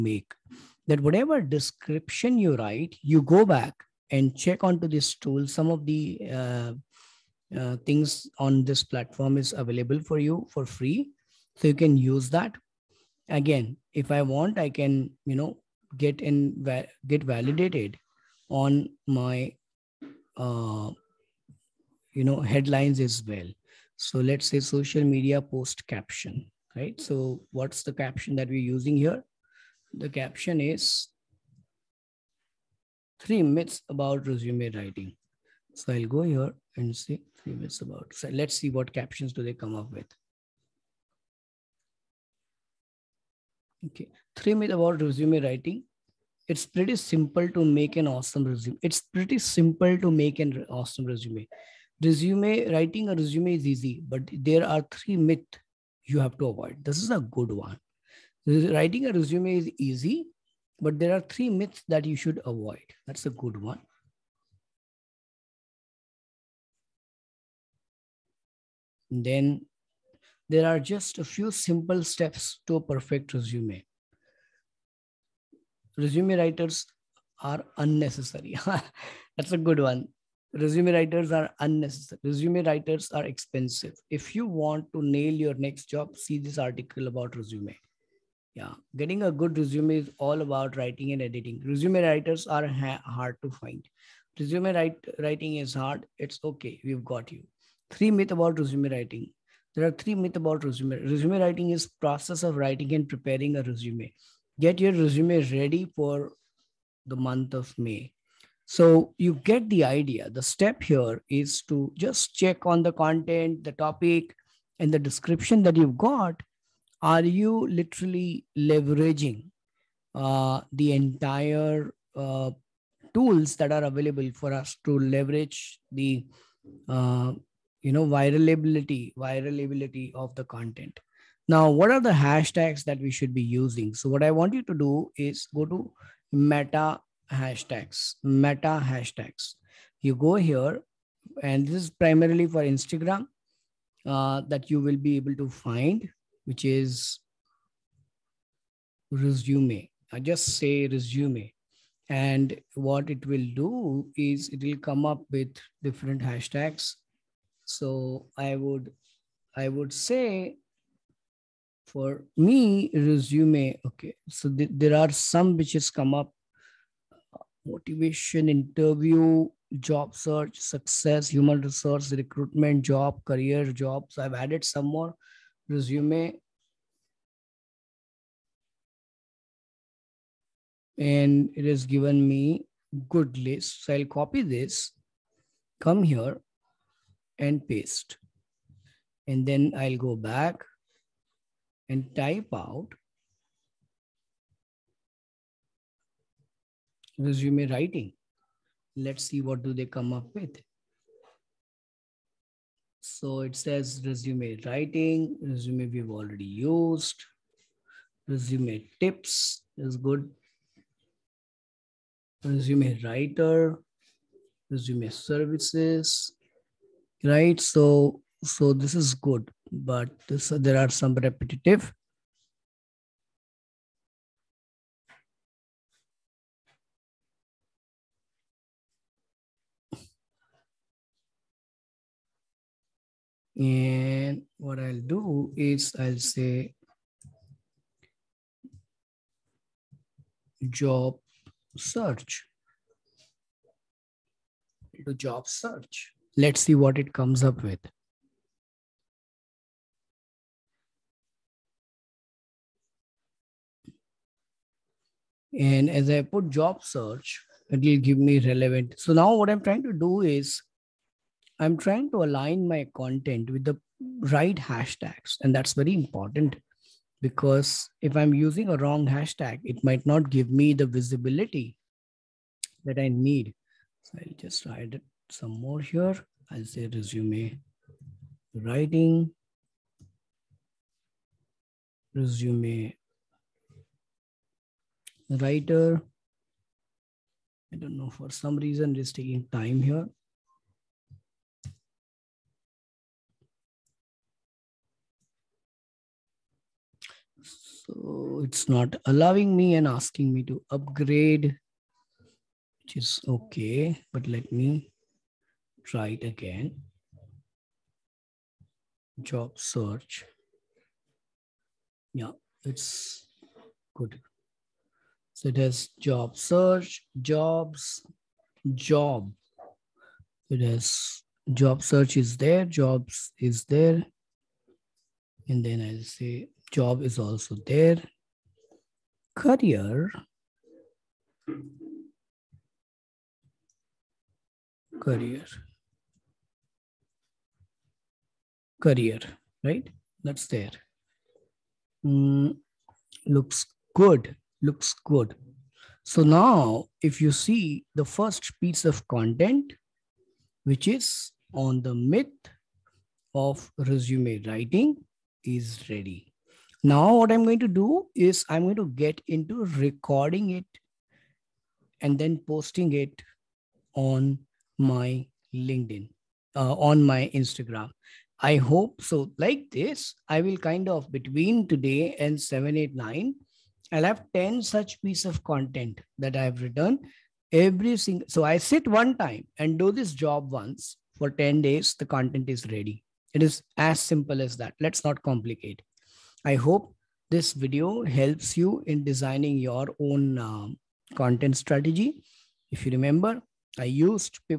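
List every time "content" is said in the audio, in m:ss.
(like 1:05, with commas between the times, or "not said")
1:52, 2:10, 4:22, 5:49, 6:15, 6:22, 6:31.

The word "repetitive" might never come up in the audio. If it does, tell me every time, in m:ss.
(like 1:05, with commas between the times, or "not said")
3:41.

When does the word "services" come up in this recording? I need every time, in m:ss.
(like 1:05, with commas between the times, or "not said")
3:35.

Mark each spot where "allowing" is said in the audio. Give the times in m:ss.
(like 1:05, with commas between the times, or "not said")
4:59.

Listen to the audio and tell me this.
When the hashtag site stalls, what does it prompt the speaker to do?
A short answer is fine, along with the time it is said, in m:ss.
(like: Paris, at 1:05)
upgrade, at 5:00.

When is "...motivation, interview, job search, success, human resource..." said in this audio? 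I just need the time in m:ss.
2:47.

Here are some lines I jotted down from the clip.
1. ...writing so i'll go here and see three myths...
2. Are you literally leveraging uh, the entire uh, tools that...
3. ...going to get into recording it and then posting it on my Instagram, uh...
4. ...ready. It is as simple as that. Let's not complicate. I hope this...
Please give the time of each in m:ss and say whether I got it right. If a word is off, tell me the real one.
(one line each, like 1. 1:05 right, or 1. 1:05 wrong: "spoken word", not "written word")
1. 0:34 right
2. 1:57 right
3. 5:58 wrong: "LinkedIn", not "Instagram"
4. 6:22 right.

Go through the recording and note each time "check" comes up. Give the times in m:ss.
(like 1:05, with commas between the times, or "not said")
0:04, 1:52.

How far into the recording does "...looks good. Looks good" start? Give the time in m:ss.
5:43.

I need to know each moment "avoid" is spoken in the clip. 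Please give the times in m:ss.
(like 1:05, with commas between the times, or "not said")
0:56, 1:02.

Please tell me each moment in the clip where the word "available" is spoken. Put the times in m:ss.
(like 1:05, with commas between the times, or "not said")
0:09, 2:03.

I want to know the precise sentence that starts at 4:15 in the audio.
And as I put job search, it will give me relevant.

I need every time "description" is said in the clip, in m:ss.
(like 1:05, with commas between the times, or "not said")
0:01, 1:54.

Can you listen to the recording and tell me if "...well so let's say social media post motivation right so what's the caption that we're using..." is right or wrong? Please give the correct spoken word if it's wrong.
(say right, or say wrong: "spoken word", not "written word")
wrong: "caption", not "motivation".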